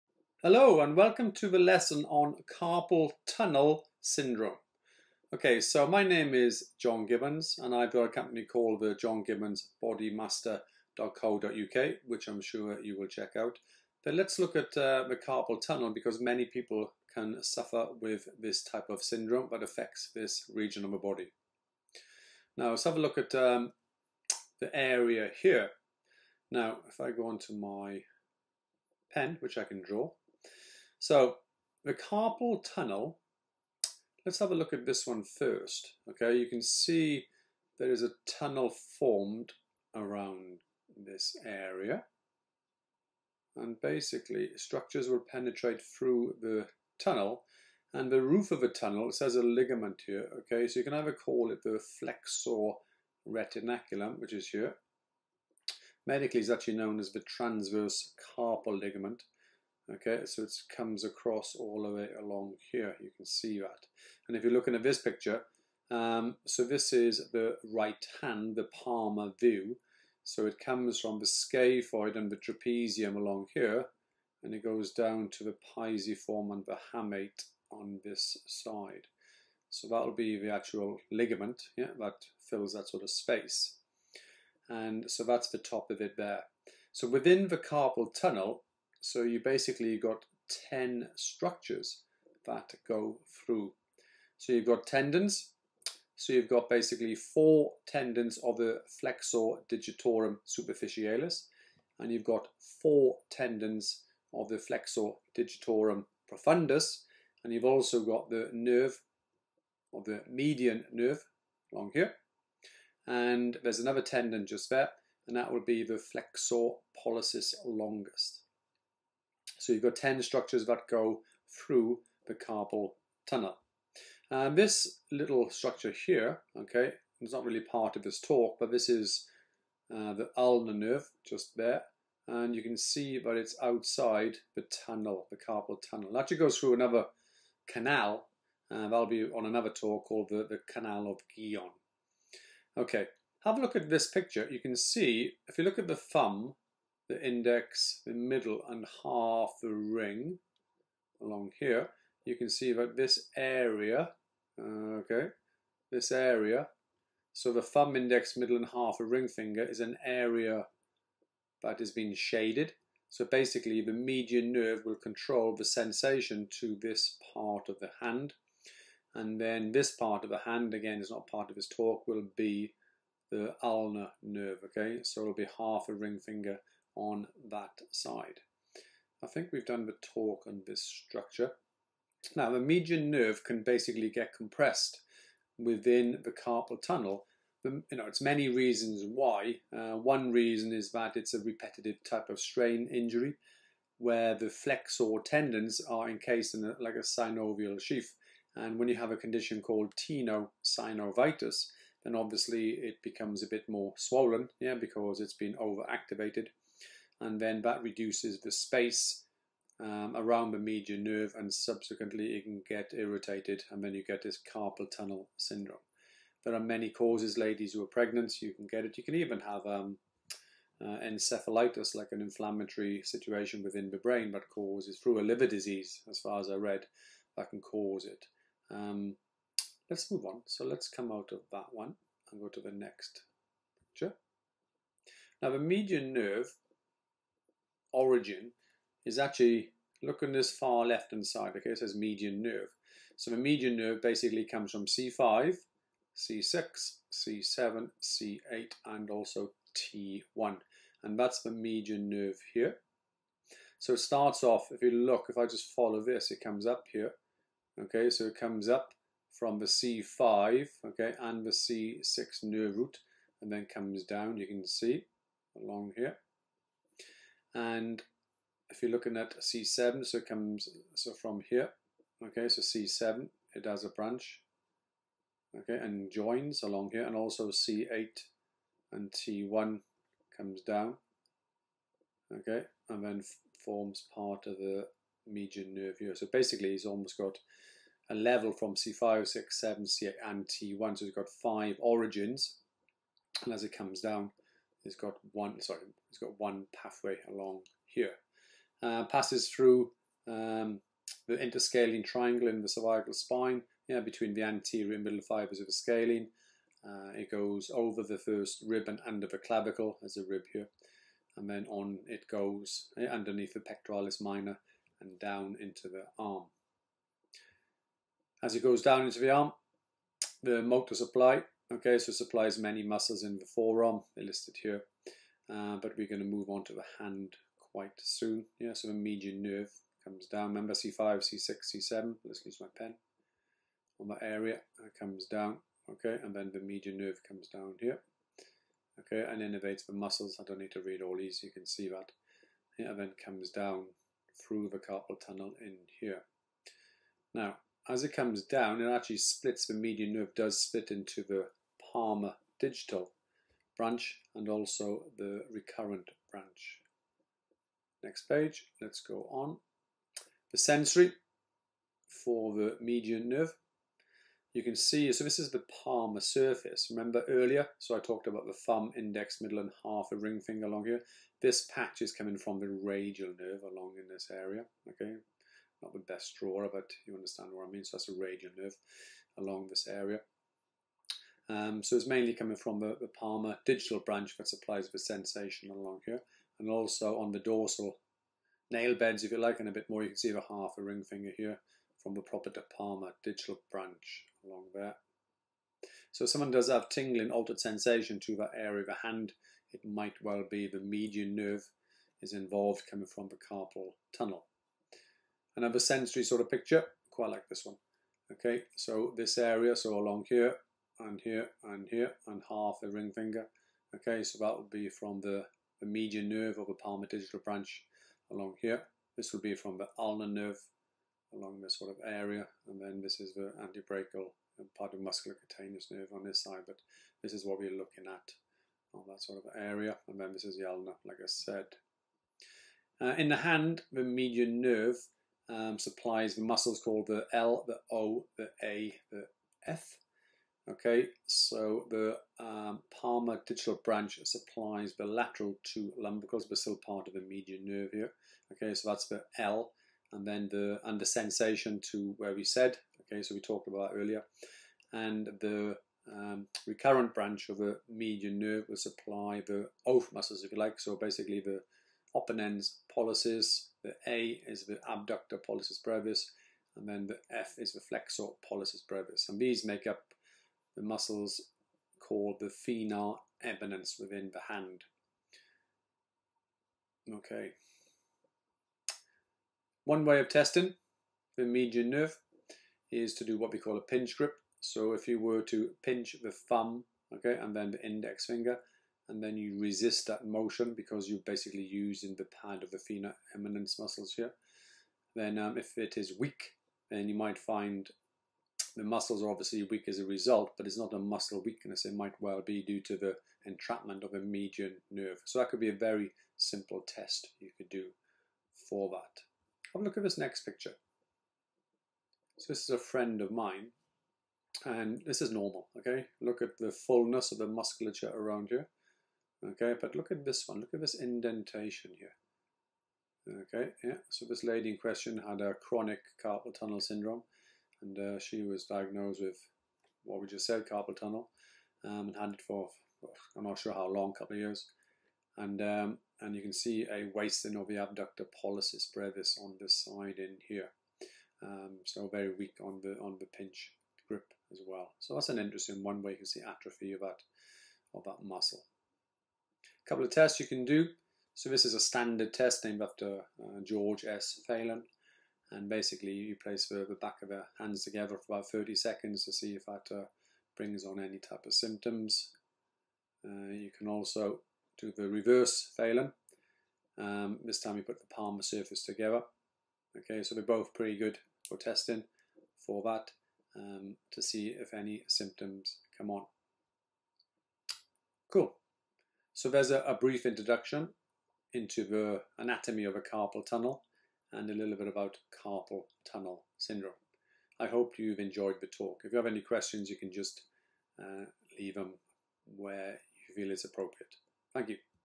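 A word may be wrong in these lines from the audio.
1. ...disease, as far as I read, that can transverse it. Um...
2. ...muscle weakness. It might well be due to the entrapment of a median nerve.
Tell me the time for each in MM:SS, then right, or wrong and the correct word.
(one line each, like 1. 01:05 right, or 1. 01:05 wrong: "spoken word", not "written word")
1. 03:45 wrong: "cause", not "transverse"
2. 08:20 right.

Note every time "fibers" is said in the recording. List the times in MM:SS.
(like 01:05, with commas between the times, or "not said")
05:05.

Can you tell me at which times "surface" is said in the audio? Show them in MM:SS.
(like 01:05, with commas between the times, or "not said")
06:06, 09:28.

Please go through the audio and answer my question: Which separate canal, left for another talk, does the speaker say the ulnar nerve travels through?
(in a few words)
Canal of Guyon.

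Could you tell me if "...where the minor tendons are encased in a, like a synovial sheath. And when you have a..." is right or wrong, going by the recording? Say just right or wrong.
wrong.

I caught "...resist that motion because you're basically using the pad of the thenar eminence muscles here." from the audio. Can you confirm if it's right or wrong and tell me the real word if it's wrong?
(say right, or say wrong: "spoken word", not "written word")
right.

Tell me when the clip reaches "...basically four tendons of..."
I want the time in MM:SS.
01:36.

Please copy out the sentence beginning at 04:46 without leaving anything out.
So basically, he's almost got a level from C5, 6, 7, C8, and T1.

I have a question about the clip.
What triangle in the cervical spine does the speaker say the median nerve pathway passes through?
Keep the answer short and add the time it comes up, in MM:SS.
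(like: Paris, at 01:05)
interscalene triangle, at 05:01.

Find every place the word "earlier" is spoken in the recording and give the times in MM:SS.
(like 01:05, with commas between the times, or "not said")
06:07, 07:33.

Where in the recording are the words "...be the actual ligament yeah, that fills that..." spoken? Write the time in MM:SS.
01:20.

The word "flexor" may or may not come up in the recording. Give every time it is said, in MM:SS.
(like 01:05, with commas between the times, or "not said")
00:51, 01:38, 01:44, 01:55, 03:14, 07:47.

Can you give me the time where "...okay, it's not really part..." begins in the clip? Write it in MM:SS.
02:06.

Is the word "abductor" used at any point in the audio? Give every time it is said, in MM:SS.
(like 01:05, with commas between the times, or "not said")
07:44, 08:57.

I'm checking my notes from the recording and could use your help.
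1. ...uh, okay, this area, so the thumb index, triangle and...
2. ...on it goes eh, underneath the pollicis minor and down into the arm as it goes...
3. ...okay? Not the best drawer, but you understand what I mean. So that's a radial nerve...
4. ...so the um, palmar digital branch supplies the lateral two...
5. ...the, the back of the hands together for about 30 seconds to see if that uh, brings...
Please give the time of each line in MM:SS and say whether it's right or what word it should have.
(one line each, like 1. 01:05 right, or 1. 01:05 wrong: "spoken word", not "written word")
1. 02:34 wrong: "middle", not "triangle"
2. 05:11 wrong: "pectoralis", not "pollicis"
3. 06:14 right
4. 07:21 right
5. 09:16 right.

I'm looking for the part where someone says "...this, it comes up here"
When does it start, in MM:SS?
04:16.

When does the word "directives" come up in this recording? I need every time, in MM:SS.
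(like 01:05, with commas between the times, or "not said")
not said.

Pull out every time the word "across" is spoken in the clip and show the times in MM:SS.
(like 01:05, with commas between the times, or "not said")
01:01.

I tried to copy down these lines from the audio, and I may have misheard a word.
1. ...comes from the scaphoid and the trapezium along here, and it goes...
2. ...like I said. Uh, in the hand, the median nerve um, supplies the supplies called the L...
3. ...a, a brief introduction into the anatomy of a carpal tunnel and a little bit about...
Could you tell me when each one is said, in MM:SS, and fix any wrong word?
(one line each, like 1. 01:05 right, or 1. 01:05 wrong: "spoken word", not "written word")
1. 01:10 right
2. 07:11 wrong: "muscles", not "supplies"
3. 09:39 right.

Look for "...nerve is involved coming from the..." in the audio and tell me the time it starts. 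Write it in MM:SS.
06:41.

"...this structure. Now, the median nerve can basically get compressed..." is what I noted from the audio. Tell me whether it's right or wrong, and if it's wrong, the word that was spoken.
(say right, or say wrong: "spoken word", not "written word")
right.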